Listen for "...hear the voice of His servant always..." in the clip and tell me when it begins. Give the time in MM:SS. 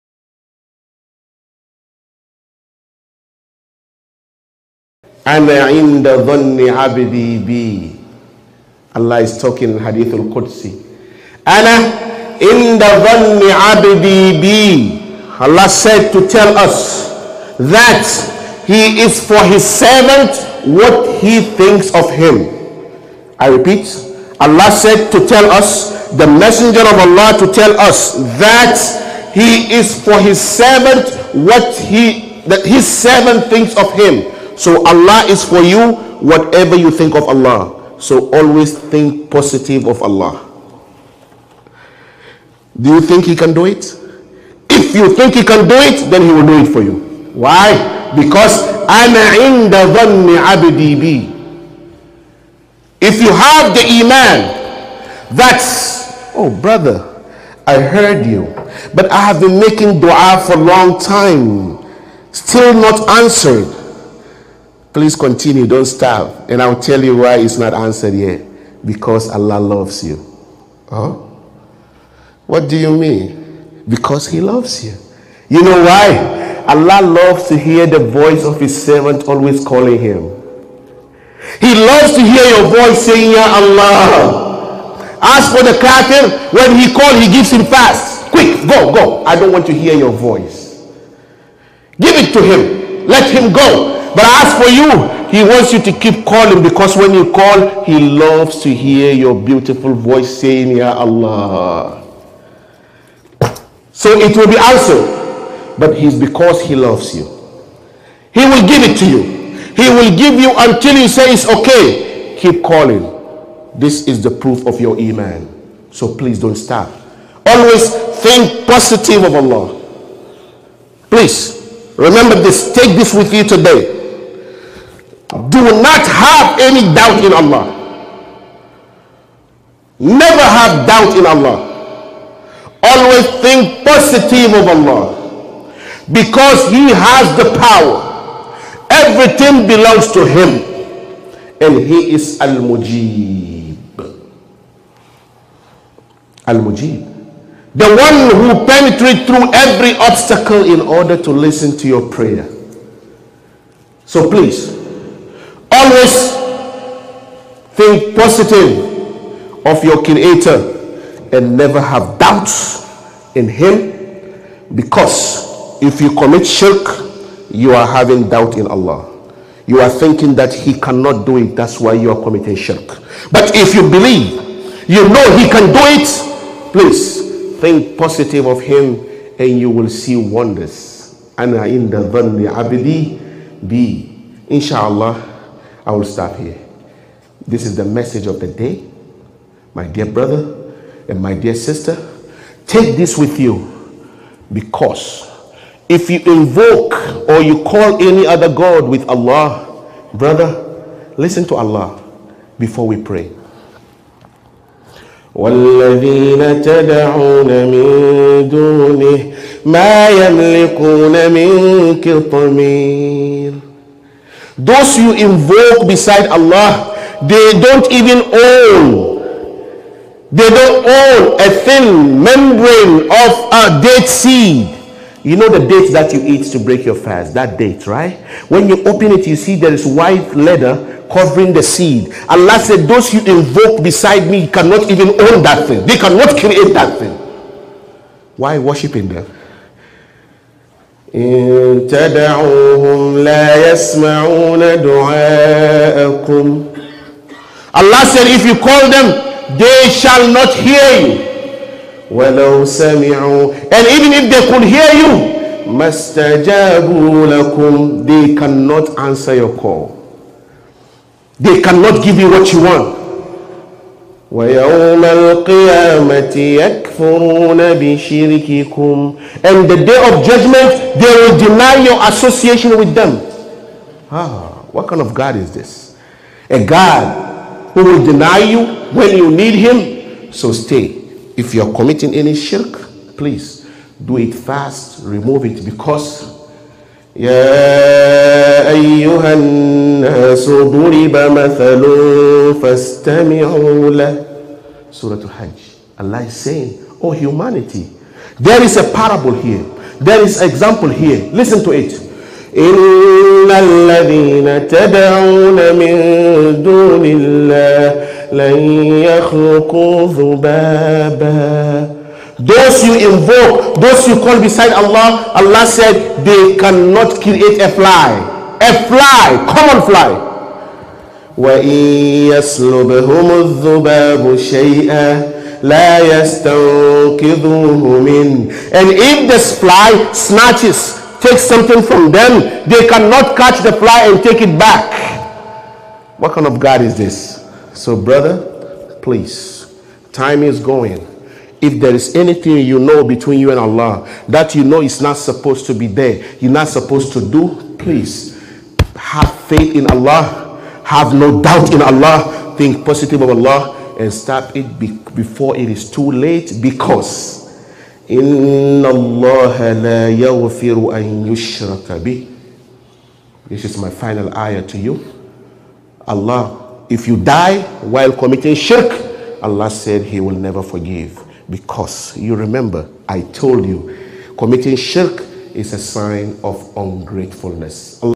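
01:17.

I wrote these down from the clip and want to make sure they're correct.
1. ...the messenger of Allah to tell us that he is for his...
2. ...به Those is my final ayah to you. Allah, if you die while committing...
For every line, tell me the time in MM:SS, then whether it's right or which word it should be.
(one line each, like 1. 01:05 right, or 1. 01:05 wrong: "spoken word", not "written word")
1. 00:26 right
2. 06:02 wrong: "This", not "Those".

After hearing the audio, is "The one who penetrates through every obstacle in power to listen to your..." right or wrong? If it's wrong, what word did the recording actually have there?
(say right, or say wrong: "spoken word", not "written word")
wrong: "order", not "power".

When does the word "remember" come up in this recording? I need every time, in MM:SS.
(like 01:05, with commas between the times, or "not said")
02:01, 06:12.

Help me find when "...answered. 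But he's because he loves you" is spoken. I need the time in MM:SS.
01:44.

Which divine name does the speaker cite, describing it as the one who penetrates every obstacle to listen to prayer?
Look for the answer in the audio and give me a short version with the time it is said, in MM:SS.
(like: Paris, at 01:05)
Al Mujib, at 02:21.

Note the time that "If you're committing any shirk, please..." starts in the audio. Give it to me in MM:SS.
04:41.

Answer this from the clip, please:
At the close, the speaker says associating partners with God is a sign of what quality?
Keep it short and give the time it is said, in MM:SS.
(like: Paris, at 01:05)
Ungratefulness, at 06:16.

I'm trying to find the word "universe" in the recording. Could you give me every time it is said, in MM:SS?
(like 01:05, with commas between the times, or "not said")
not said.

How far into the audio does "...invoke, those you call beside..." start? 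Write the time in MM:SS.
05:12.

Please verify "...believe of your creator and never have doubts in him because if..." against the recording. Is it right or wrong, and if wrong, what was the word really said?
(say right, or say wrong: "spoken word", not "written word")
wrong: "positive", not "believe".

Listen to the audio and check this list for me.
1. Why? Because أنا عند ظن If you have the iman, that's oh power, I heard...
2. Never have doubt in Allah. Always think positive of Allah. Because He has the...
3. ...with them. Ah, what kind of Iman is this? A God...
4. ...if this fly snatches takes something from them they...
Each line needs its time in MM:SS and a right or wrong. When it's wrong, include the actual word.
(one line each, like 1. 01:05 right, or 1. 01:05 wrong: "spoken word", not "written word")
1. 00:47 wrong: "brother", not "power"
2. 02:09 right
3. 04:32 wrong: "God", not "Iman"
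4. 05:28 right.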